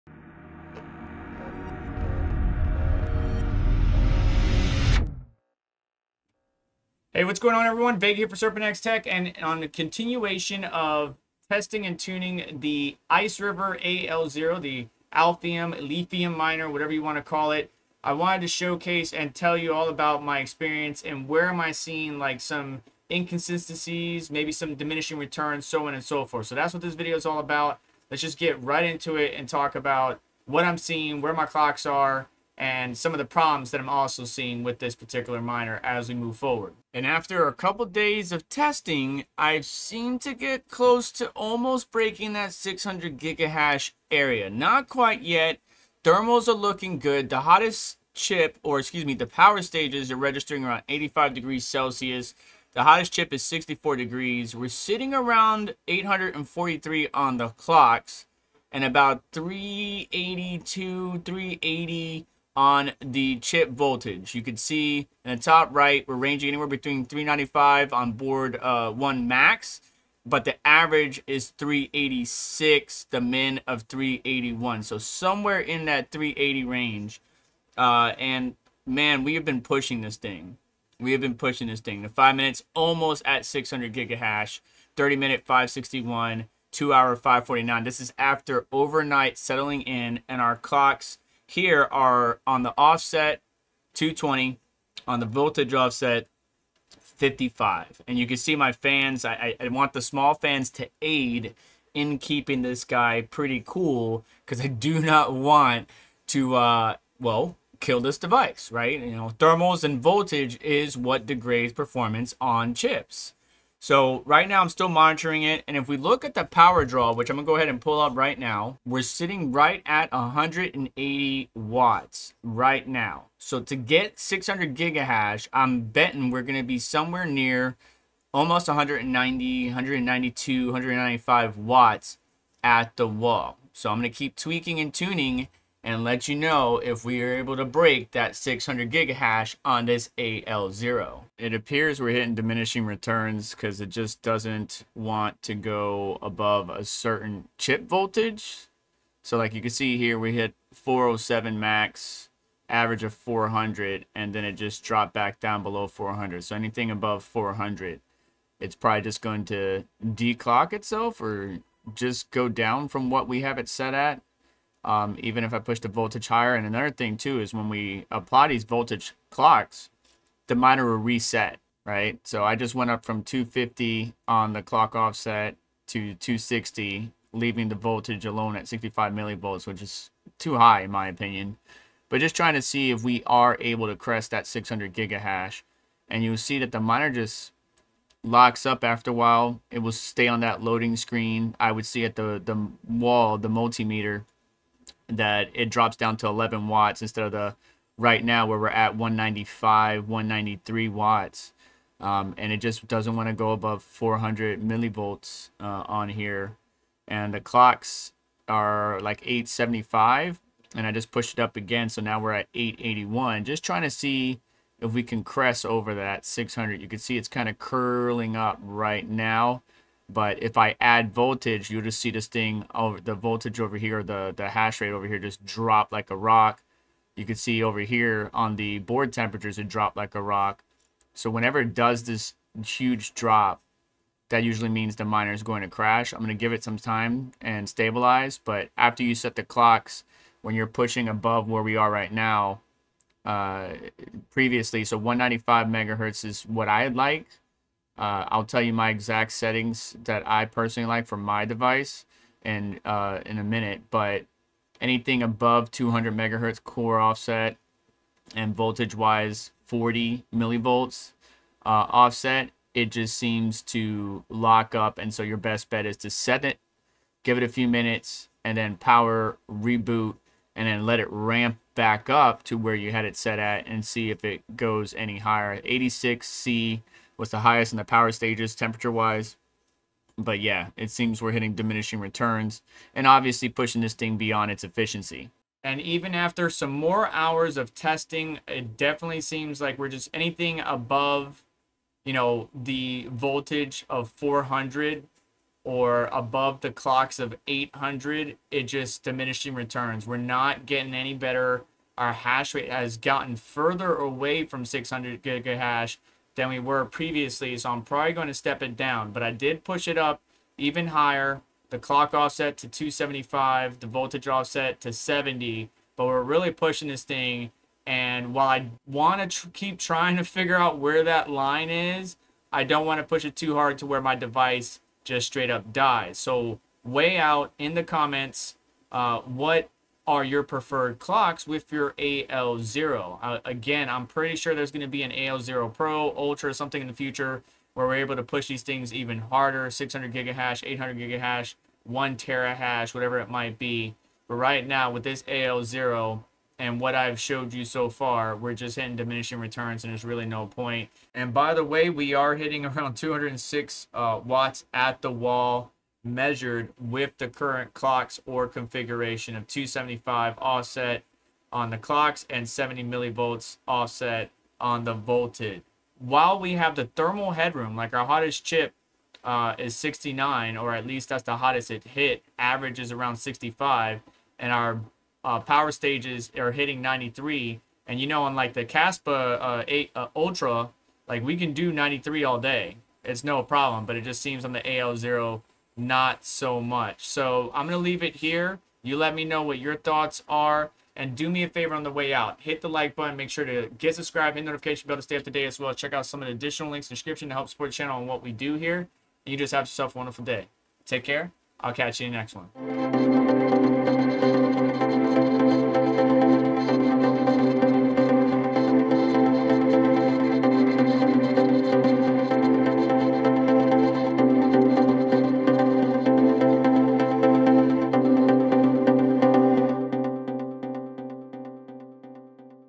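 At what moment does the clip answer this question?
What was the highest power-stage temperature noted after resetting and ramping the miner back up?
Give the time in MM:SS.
04:35.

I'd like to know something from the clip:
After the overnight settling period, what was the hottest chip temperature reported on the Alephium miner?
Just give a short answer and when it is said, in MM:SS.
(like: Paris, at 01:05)
64 degrees, at 00:52.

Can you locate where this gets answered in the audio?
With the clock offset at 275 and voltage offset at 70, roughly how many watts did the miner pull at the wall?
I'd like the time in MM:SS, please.
05:52.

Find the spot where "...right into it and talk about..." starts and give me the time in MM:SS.
00:28.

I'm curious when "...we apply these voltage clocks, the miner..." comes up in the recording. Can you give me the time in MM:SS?
02:47.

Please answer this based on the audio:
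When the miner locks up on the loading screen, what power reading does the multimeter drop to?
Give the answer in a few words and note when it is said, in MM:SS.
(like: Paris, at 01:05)
11 watts, at 03:16.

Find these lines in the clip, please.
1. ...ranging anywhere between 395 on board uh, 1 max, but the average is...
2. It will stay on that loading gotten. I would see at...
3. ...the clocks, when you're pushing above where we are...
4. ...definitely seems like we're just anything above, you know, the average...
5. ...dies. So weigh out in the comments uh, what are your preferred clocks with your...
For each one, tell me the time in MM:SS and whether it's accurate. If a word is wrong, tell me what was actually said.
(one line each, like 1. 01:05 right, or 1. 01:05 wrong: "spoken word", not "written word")
1. 01:06 right
2. 03:09 wrong: "screen", not "gotten"
3. 03:59 right
4. 04:48 wrong: "voltage", not "average"
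5. 05:25 right.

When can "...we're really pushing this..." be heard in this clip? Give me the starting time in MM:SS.
05:16.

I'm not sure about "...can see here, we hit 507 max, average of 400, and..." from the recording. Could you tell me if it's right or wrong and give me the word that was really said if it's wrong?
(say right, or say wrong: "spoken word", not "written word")
wrong: "407", not "507".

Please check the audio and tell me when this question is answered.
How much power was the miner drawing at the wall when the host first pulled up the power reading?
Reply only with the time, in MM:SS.
02:00.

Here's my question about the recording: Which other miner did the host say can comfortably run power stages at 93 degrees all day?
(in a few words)
Kaspa 8 Ultra.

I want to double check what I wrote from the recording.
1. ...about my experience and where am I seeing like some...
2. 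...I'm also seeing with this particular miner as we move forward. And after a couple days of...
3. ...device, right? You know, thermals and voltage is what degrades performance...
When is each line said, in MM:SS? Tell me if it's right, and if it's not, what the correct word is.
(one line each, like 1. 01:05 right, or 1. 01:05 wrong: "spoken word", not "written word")
1. 00:19 right
2. 00:33 right
3. 01:48 right.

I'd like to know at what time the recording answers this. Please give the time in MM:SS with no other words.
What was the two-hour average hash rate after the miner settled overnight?
01:26.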